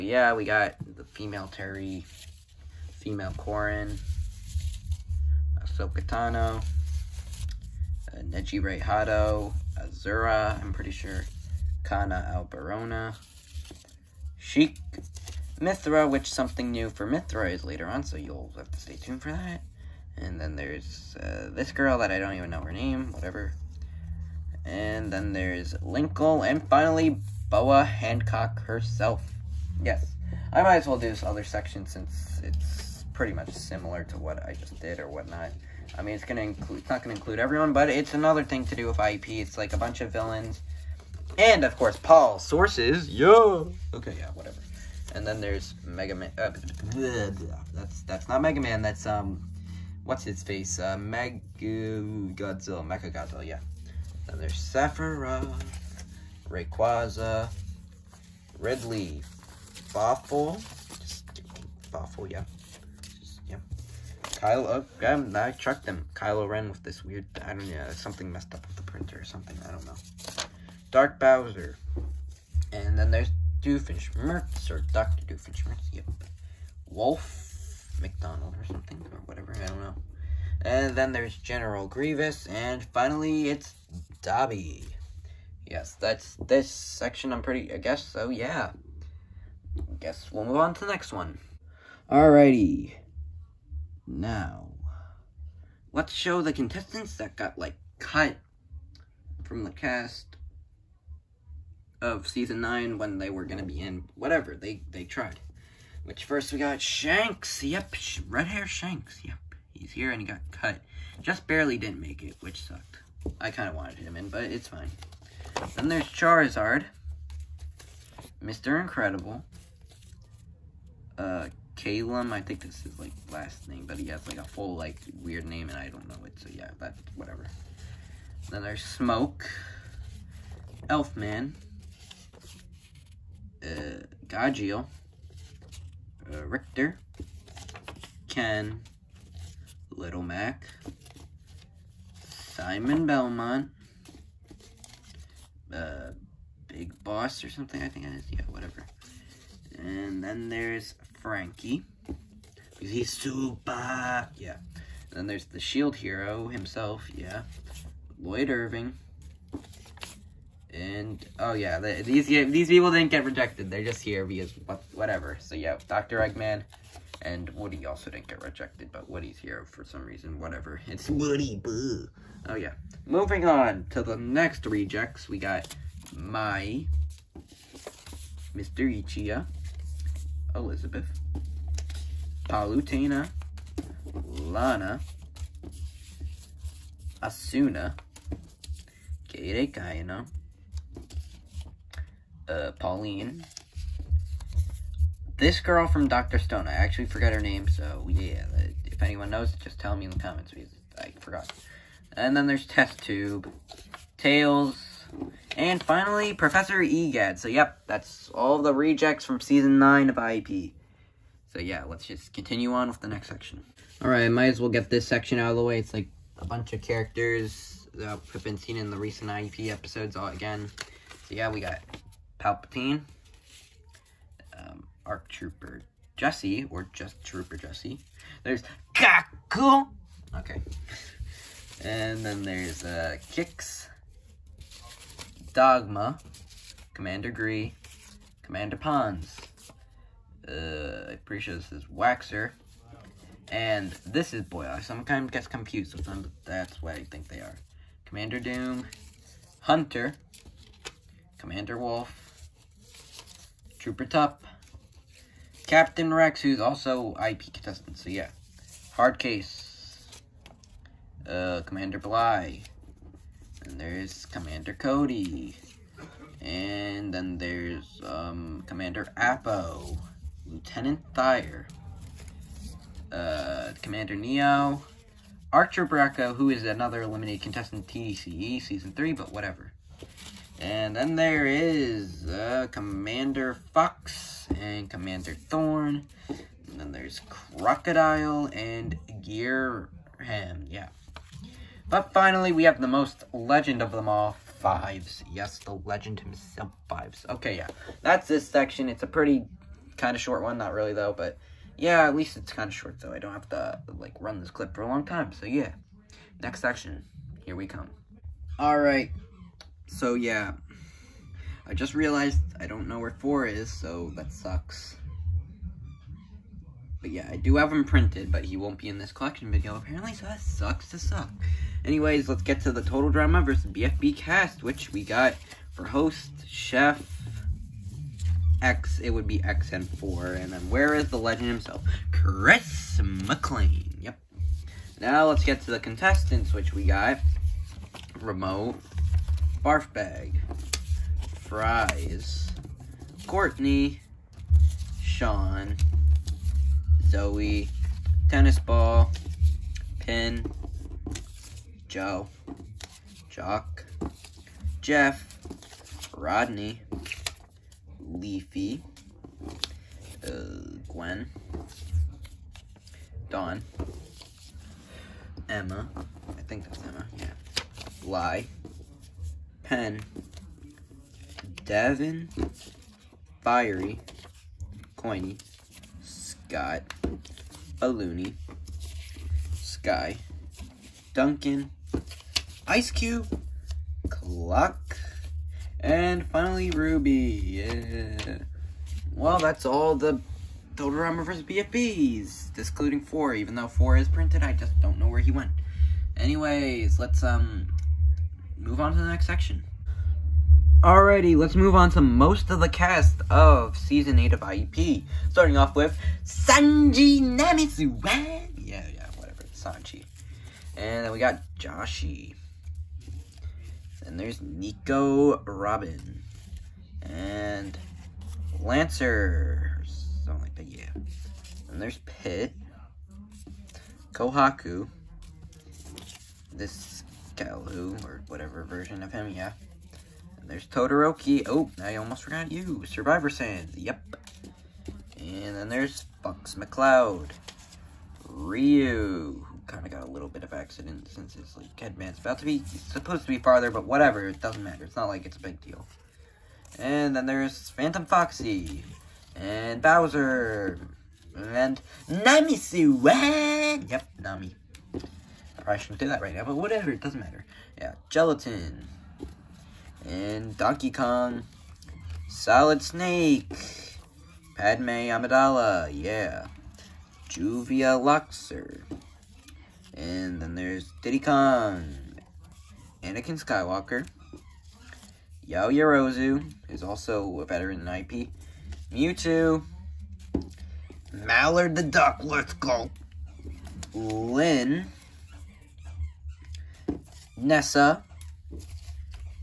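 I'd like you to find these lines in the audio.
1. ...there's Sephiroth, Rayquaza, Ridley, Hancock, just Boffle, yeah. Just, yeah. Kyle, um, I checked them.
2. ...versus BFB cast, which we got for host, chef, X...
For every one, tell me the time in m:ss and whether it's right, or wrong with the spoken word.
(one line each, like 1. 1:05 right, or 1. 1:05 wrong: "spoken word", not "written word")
1. 0:54 wrong: "Boffle", not "Hancock"
2. 5:23 right.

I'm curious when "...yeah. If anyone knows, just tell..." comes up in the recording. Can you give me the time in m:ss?
3:18.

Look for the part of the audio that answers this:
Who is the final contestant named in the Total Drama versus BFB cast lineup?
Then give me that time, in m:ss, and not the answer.
6:26.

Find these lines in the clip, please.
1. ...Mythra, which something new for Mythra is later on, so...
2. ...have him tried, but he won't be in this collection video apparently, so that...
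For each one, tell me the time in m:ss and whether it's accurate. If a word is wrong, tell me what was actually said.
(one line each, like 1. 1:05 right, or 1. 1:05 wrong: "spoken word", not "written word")
1. 0:15 right
2. 5:17 wrong: "printed", not "tried".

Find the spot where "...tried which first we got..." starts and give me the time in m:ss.
1:45.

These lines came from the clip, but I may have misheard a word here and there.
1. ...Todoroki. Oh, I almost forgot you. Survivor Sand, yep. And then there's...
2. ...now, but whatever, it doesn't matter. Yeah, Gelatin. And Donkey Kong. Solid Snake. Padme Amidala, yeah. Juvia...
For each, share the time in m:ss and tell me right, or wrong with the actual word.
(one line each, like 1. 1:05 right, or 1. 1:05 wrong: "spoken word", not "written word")
1. 7:10 right
2. 7:36 right.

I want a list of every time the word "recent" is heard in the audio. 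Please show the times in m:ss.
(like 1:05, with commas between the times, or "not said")
3:38.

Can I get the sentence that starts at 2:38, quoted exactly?
Lloyd Irving, and, oh yeah, these these people didn't get rejected.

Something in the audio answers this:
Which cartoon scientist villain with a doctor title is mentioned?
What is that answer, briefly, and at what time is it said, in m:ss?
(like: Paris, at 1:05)
Dr. Doofenshmirtz, at 1:14.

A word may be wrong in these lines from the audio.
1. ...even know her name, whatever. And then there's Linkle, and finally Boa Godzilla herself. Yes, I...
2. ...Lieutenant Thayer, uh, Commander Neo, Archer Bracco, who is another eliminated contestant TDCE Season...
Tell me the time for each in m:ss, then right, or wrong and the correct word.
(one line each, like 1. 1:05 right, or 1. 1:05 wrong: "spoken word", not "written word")
1. 0:22 wrong: "Hancock", not "Godzilla"
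2. 4:30 right.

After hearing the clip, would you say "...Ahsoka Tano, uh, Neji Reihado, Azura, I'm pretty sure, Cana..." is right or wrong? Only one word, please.
right.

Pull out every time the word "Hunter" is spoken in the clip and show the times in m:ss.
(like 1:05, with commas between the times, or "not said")
4:09.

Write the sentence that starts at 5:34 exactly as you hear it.
Now let's get to the contestants, which we got.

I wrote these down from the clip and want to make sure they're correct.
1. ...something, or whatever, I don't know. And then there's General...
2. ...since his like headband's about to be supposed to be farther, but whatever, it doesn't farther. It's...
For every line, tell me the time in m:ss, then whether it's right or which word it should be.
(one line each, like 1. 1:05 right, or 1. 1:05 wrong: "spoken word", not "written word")
1. 1:18 right
2. 7:21 wrong: "matter", not "farther".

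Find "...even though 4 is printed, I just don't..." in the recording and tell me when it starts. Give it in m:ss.
6:33.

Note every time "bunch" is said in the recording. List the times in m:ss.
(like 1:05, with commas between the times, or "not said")
0:39, 3:36.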